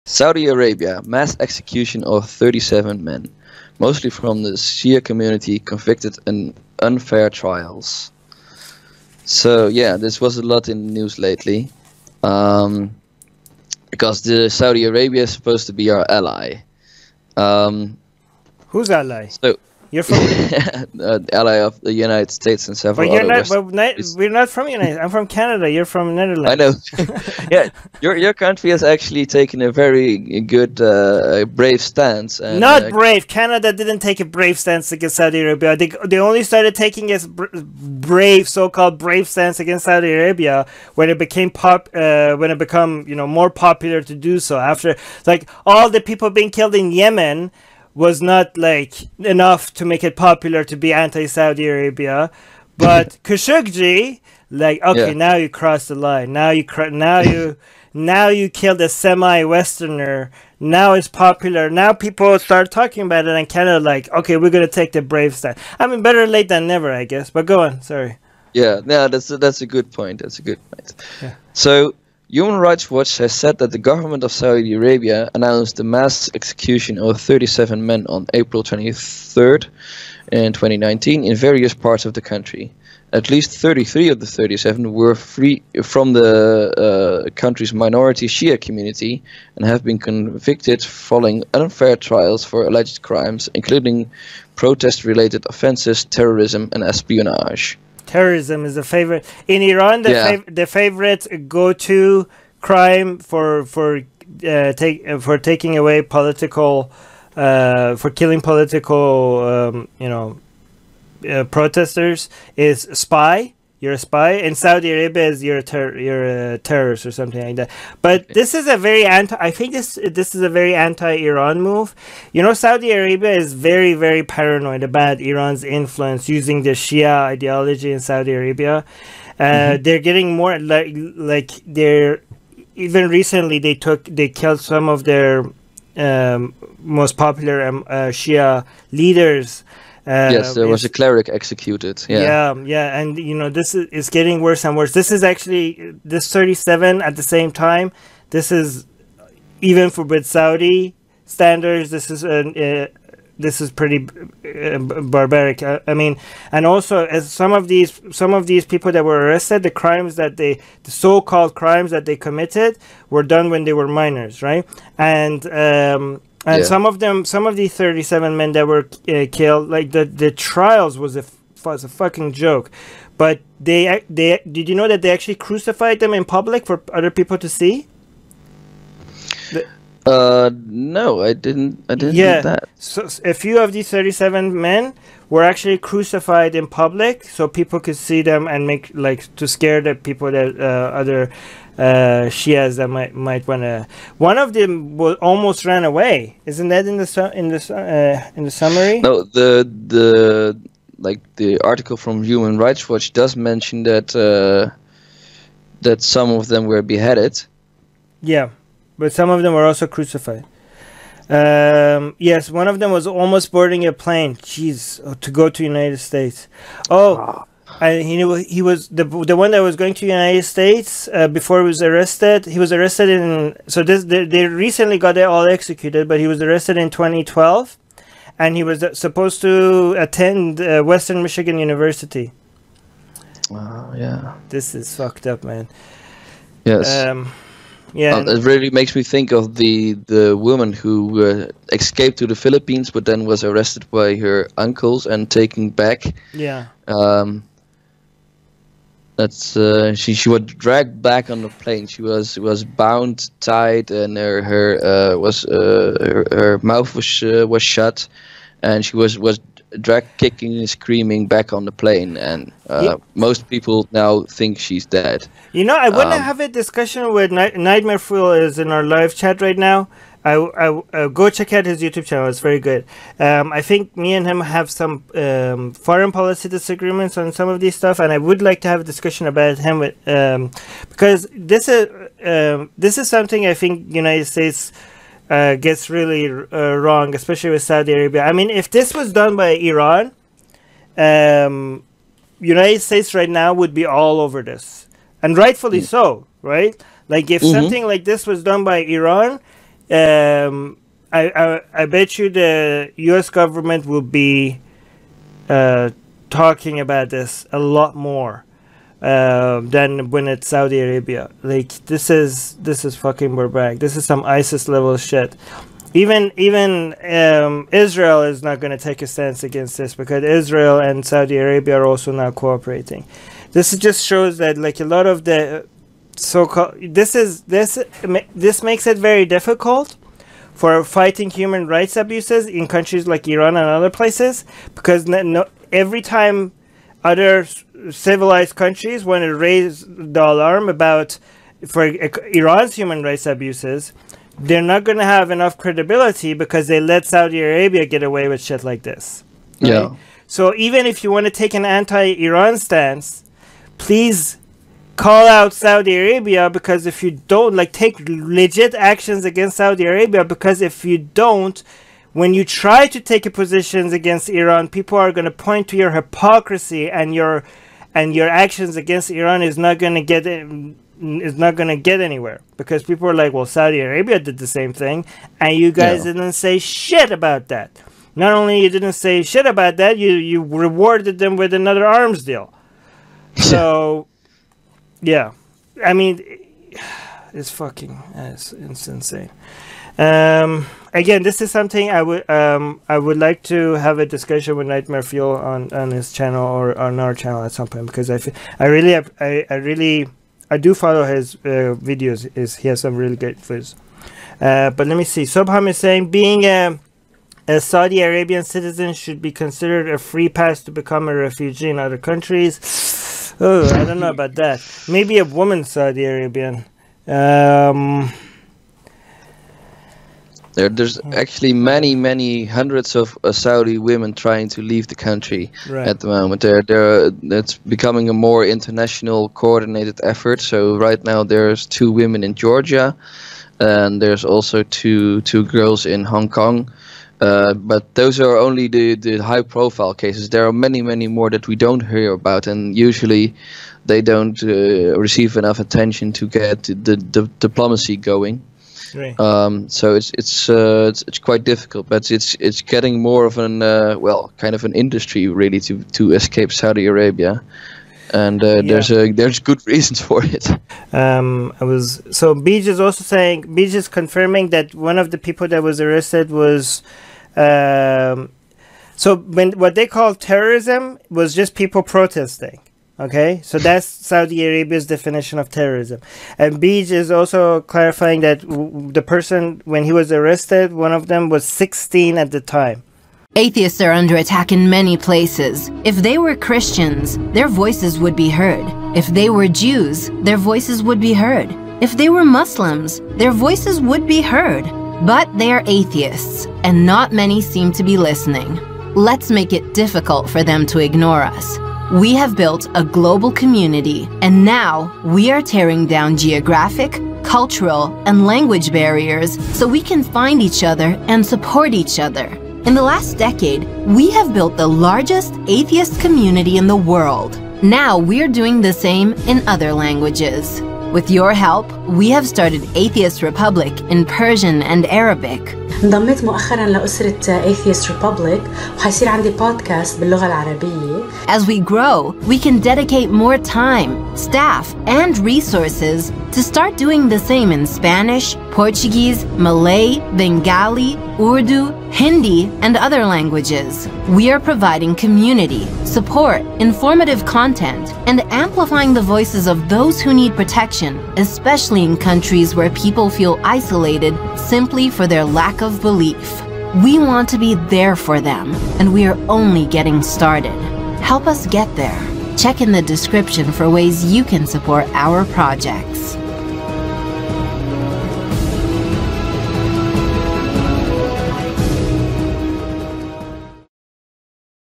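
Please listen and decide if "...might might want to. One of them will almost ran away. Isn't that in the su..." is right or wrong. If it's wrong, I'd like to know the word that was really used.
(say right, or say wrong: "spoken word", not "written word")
right.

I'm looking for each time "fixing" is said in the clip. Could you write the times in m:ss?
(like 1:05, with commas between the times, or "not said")
not said.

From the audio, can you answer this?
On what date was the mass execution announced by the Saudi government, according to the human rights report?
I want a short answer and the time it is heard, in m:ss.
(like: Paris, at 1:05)
April 23rd, at 1:18.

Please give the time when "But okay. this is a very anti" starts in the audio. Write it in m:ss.
1:58.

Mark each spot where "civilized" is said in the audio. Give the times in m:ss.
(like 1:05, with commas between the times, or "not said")
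5:37.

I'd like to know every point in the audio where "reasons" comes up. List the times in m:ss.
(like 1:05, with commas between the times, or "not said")
7:39.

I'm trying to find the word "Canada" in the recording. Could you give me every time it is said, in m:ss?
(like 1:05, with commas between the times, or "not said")
0:25, 0:33.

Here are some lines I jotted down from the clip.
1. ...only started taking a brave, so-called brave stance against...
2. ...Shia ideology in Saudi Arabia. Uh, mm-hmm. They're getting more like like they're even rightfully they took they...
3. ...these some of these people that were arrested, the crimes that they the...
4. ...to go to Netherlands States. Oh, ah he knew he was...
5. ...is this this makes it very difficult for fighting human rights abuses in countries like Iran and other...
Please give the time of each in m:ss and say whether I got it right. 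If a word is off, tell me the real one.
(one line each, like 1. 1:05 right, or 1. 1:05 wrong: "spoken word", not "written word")
1. 0:36 right
2. 2:06 wrong: "recently", not "rightfully"
3. 2:37 right
4. 3:35 wrong: "United", not "Netherlands"
5. 5:27 right.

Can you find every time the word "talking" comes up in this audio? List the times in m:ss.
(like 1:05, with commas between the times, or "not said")
1:02, 5:06.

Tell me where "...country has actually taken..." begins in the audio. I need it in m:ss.
0:28.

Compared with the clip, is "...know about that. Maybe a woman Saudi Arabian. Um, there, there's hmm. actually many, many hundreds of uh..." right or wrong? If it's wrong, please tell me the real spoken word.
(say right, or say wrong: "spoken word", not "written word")
right.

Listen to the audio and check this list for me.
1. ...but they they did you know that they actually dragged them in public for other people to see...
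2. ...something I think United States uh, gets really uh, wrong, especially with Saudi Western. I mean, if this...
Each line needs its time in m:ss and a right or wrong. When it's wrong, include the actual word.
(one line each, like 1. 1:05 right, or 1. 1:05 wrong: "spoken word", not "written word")
1. 2:53 wrong: "crucified", not "dragged"
2. 4:43 wrong: "Arabia", not "Western".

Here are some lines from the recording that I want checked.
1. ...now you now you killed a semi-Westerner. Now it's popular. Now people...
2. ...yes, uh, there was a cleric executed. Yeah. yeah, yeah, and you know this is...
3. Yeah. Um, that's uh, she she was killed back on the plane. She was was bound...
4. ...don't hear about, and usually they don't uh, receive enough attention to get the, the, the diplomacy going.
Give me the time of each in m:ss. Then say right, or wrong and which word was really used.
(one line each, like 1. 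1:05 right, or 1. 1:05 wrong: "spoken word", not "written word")
1. 0:56 right
2. 2:20 right
3. 4:06 wrong: "dragged", not "killed"
4. 7:21 right.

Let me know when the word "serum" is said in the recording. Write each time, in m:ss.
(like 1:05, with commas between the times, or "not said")
not said.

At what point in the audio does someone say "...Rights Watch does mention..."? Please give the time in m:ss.
3:22.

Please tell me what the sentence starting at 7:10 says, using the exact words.
So right now there's two women in Georgia, and there's also two two girls in Hong Kong.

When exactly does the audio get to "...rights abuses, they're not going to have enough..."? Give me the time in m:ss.
5:43.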